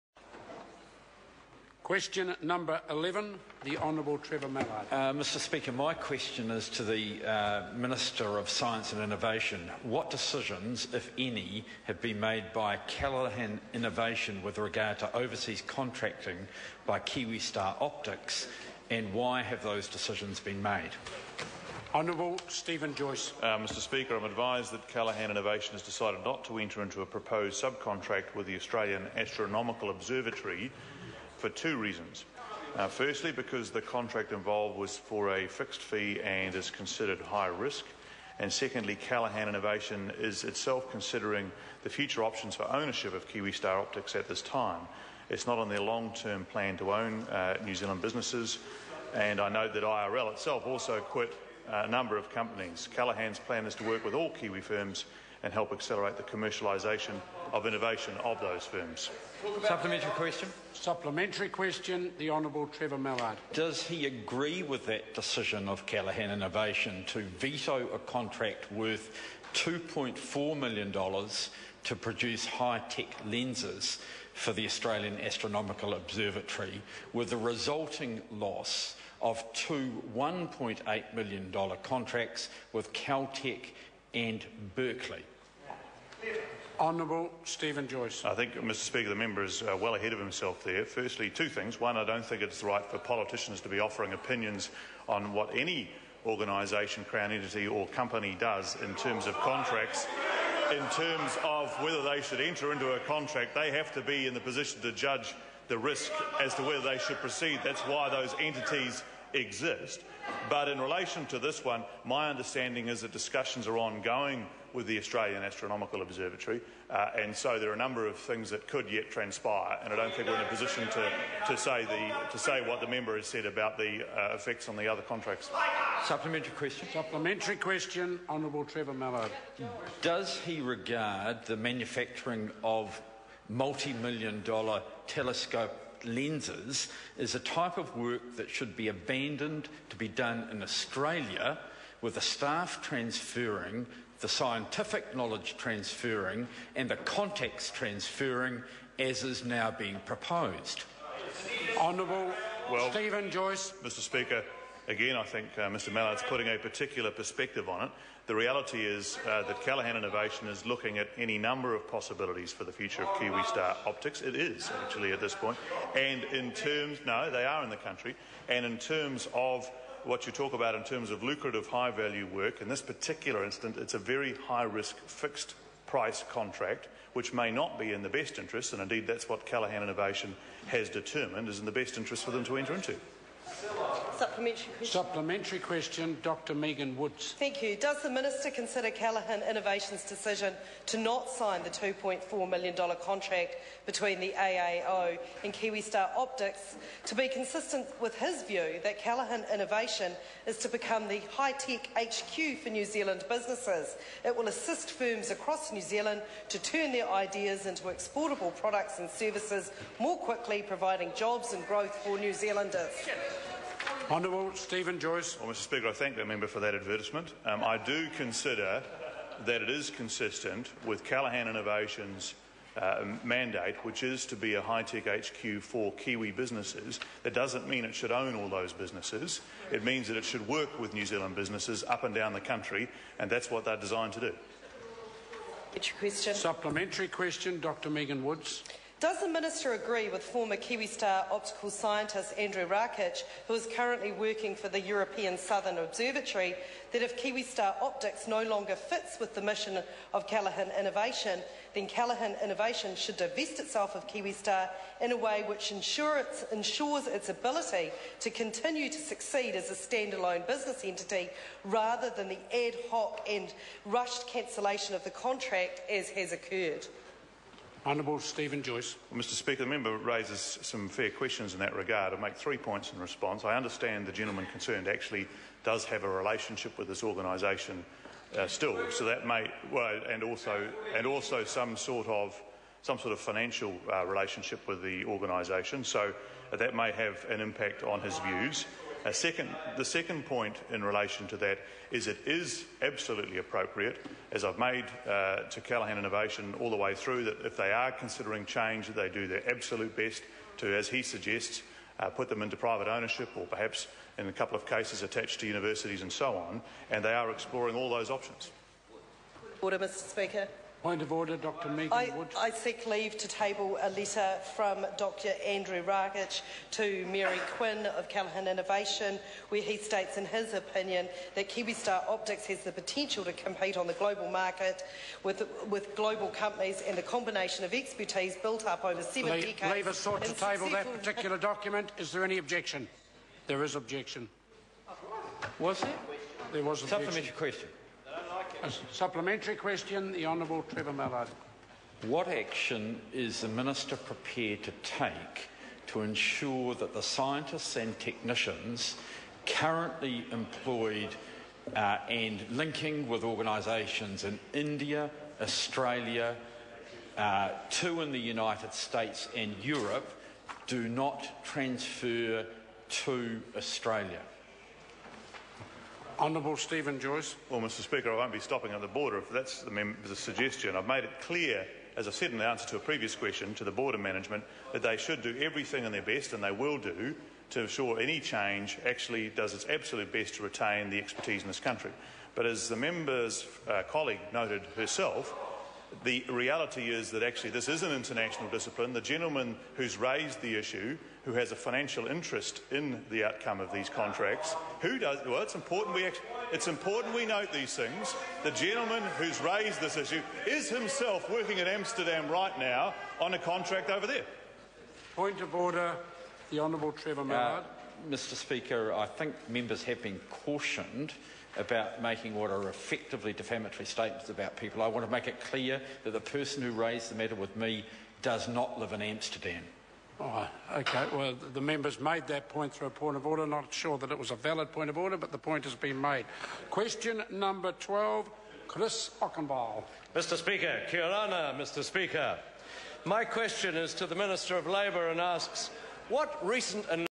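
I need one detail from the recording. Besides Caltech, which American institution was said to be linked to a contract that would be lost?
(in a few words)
Berkeley.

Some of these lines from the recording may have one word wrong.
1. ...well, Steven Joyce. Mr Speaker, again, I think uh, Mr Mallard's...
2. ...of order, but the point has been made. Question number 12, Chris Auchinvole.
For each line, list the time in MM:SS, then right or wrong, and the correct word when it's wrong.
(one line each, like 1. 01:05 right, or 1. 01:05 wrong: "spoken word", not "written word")
1. 02:32 right
2. 07:04 right.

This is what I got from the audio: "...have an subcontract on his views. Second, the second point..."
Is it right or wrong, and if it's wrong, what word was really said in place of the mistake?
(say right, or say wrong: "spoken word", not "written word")
wrong: "impact", not "subcontract".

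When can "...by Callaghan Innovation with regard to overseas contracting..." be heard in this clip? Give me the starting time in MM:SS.
00:12.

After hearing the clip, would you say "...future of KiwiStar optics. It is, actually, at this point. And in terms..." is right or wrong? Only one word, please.
right.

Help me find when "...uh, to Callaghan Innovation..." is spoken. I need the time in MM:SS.
04:55.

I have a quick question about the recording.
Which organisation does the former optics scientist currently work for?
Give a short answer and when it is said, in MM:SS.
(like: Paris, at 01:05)
European Southern Observatory, at 04:04.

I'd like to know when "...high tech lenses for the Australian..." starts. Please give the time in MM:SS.
01:12.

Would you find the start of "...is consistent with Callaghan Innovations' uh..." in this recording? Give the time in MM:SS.
03:39.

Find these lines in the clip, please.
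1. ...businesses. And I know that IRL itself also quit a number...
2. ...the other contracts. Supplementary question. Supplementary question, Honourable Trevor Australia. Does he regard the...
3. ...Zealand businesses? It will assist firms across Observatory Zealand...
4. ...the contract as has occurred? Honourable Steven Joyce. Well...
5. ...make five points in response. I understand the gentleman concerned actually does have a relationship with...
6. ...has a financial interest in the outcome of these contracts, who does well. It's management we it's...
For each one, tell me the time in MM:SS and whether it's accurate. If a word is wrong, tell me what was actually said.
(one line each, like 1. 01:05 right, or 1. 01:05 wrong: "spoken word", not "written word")
1. 00:48 right
2. 02:04 wrong: "Mallard", not "Australia"
3. 03:22 wrong: "New", not "Observatory"
4. 04:25 right
5. 04:32 wrong: "three", not "five"
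6. 06:31 wrong: "important", not "management".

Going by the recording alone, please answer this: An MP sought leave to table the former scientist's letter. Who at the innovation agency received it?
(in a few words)
Mary Quin.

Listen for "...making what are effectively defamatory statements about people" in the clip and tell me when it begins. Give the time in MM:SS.
06:52.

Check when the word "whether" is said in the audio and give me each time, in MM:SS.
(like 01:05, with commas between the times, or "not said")
01:41, 01:46.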